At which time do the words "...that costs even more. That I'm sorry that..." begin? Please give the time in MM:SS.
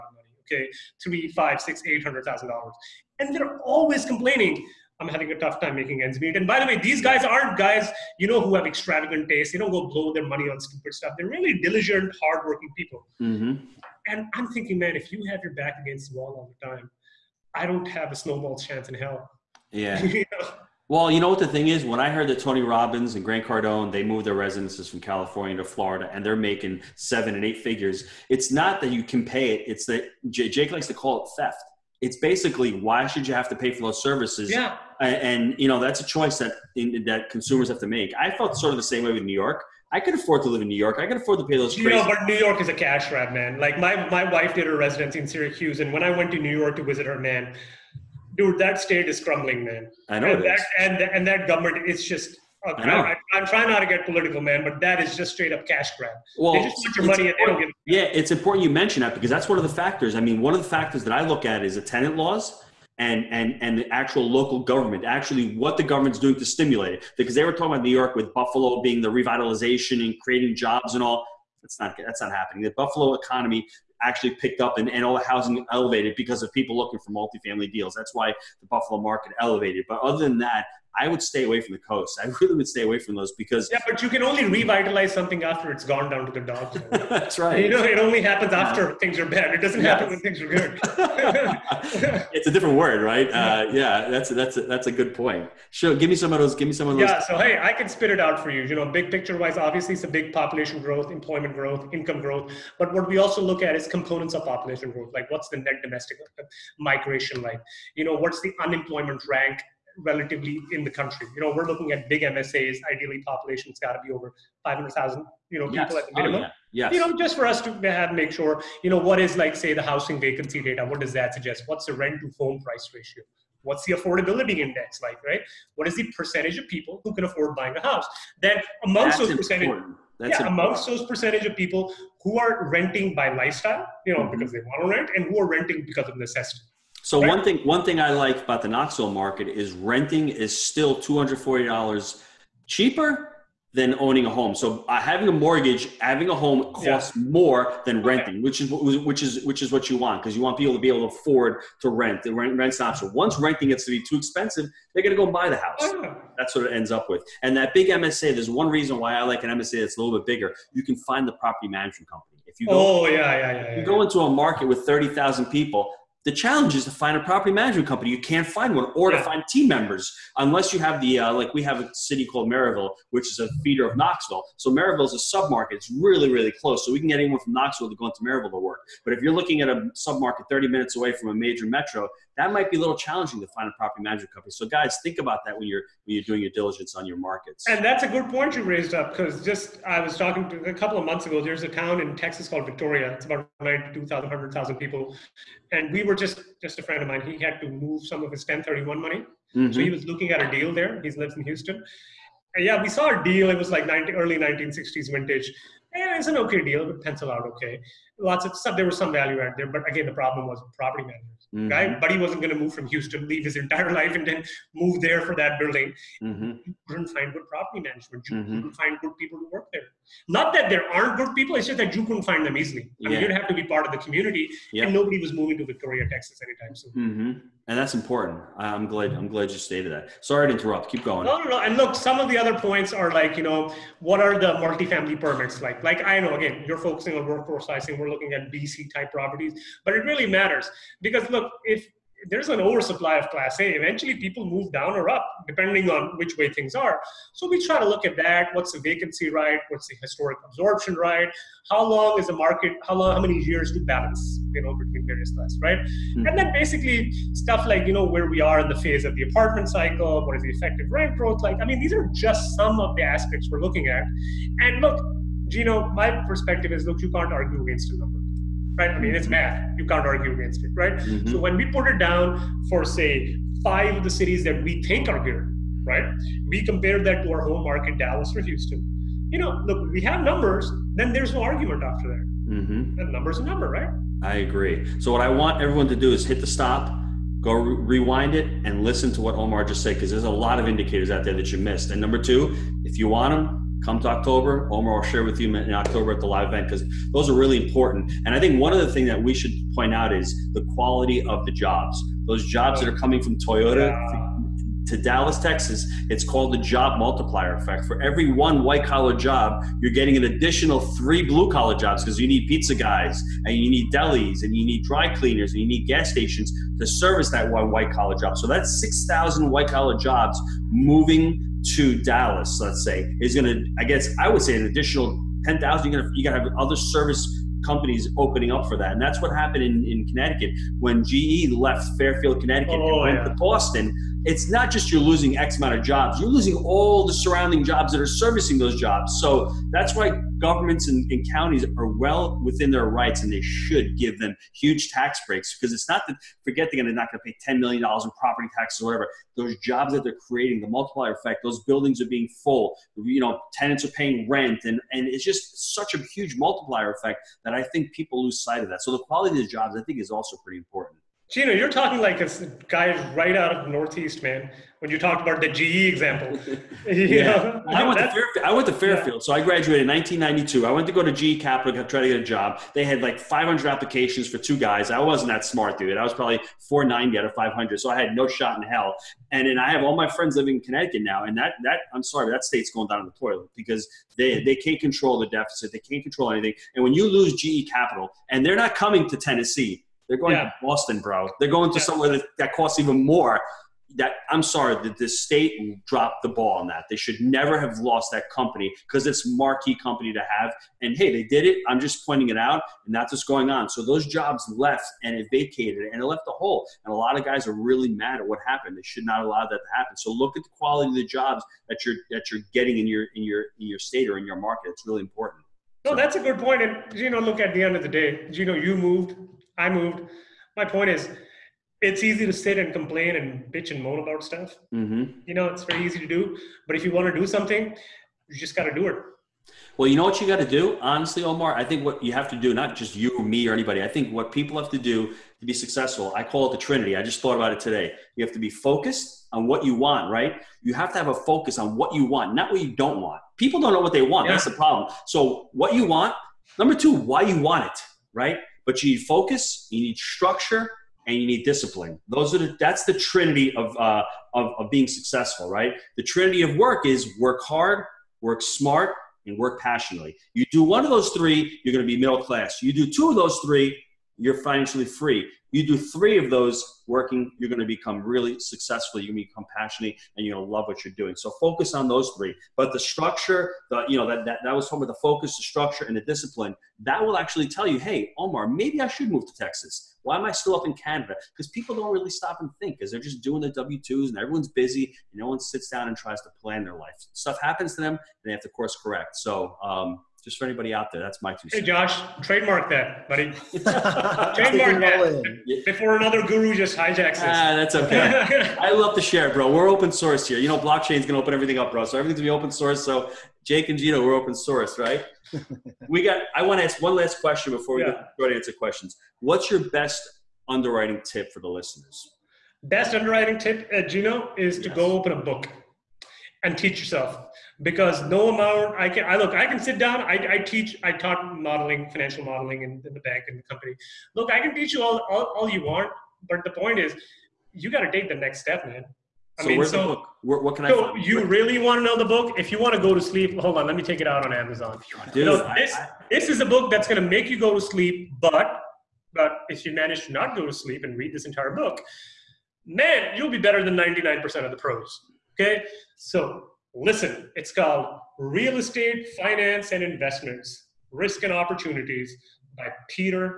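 06:32.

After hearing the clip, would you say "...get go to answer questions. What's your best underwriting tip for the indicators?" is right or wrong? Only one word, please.
wrong.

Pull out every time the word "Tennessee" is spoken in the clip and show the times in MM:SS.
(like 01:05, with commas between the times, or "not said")
06:29.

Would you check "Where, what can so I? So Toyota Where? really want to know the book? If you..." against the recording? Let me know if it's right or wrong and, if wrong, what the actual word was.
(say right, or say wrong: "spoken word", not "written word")
wrong: "You", not "Toyota".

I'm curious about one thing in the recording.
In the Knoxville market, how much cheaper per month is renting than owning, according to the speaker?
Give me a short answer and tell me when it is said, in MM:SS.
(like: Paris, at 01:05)
$240, at 02:20.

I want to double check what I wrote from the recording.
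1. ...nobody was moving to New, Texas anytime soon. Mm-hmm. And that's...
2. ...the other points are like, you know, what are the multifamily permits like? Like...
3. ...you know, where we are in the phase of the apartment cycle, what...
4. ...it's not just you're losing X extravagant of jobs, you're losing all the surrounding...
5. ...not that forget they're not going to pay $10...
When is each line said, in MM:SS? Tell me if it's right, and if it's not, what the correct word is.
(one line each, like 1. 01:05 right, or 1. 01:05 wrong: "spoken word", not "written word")
1. 03:44 wrong: "Victoria", not "New"
2. 03:52 right
3. 04:17 right
4. 05:34 wrong: "amount", not "extravagant"
5. 05:45 right.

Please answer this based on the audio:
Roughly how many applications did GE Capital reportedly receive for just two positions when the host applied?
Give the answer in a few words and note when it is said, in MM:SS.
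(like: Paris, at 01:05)
500, at 06:13.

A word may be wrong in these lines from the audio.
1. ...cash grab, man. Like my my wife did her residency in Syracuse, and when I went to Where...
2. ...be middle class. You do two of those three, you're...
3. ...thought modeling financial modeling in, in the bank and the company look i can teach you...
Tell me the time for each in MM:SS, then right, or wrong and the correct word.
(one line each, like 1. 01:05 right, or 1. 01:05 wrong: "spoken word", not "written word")
1. 00:42 wrong: "New", not "Where"
2. 07:41 right
3. 08:40 wrong: "taught", not "thought".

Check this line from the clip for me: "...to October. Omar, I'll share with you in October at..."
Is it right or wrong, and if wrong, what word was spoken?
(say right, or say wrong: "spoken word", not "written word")
right.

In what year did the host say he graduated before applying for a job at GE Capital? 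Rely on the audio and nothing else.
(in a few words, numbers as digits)
1992.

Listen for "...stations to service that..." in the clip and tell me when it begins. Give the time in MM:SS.
05:16.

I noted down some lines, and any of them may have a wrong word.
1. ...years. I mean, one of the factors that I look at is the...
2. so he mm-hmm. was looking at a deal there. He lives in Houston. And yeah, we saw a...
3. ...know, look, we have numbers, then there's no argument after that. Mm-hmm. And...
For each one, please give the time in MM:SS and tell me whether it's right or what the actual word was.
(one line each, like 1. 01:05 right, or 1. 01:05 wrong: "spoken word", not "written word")
1. 00:59 wrong: "factors", not "years"
2. 03:19 right
3. 04:39 right.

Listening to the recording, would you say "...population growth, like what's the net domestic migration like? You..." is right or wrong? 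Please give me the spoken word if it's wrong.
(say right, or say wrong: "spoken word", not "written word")
right.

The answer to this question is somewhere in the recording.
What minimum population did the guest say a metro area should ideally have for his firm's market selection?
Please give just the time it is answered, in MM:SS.
01:54.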